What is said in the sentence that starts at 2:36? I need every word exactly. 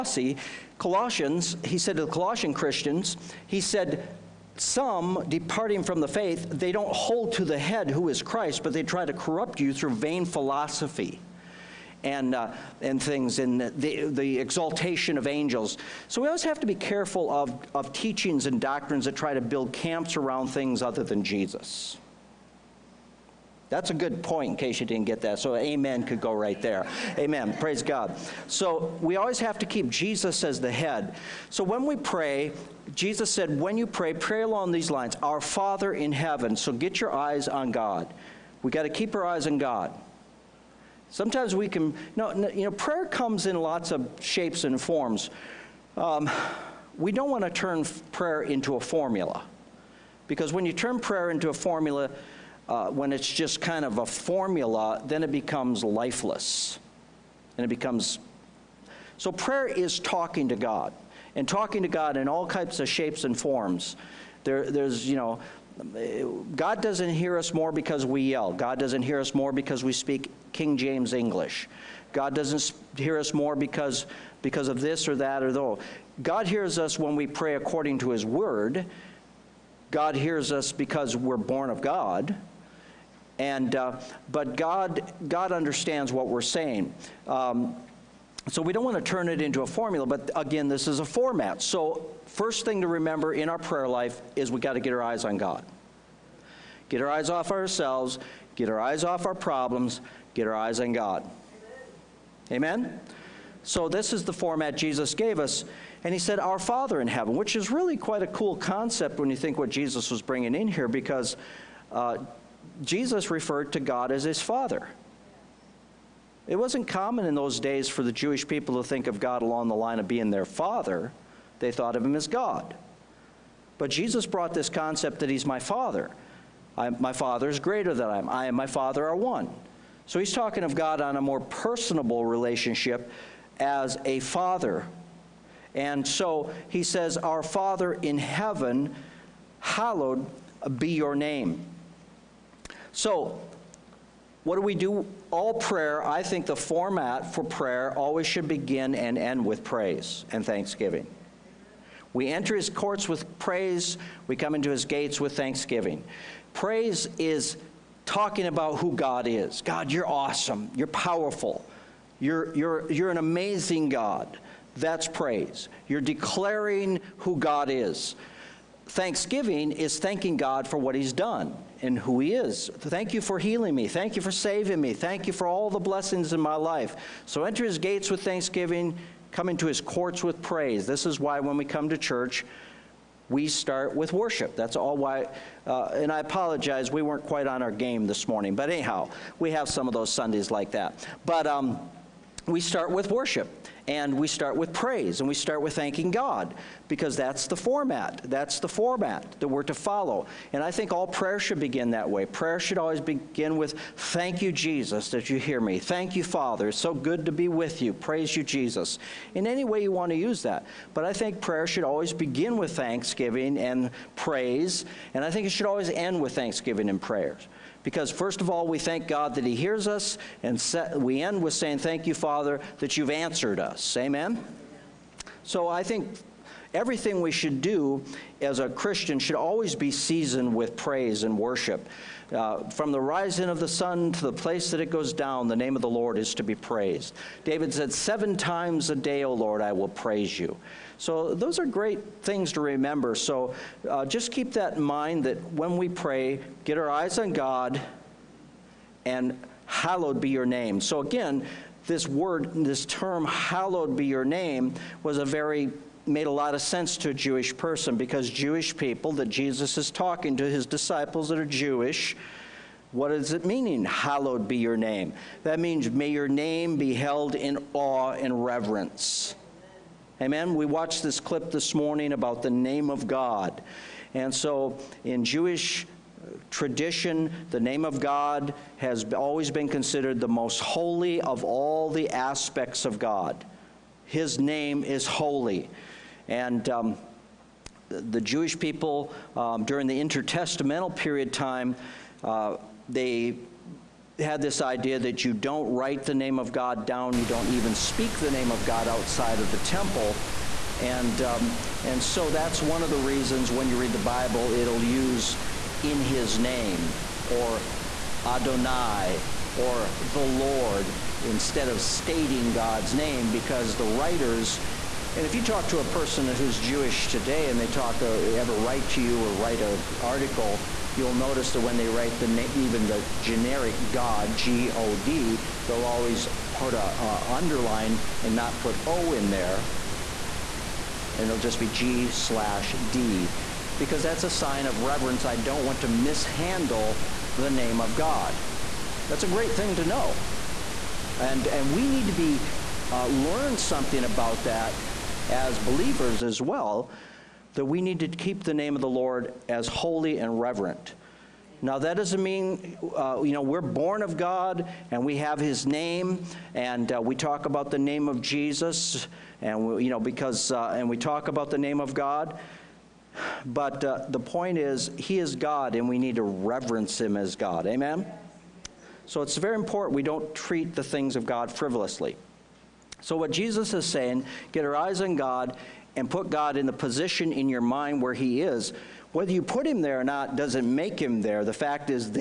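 Praise is talking about who God is.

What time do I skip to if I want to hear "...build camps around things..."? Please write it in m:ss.
0:19.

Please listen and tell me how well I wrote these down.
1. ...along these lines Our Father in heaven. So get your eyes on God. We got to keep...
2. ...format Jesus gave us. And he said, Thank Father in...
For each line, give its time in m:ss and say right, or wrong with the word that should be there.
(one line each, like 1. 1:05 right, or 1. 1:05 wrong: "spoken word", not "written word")
1. 0:34 right
2. 1:44 wrong: "Our", not "Thank".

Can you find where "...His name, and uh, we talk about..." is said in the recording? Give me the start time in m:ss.
5:55.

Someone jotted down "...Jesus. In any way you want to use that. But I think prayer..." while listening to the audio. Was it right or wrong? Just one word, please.
right.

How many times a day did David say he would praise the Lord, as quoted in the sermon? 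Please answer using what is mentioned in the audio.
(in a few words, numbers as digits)
7.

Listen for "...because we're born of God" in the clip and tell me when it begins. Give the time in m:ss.
1:20.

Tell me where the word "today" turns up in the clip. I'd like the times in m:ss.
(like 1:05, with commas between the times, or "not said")
5:17.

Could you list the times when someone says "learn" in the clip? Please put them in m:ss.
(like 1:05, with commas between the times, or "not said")
5:43.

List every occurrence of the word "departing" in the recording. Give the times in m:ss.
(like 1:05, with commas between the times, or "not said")
0:05.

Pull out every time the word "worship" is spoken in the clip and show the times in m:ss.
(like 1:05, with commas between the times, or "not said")
3:04, 3:13, 3:51.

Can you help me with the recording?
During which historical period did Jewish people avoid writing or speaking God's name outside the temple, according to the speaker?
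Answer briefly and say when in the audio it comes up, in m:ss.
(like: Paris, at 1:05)
intertestamental period, at 4:50.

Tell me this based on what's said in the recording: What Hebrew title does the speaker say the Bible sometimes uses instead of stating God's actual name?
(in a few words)
Adonai.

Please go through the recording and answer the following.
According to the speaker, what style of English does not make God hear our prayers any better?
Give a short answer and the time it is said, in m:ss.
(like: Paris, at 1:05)
King James English, at 1:10.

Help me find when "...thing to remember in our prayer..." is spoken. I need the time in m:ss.
1:32.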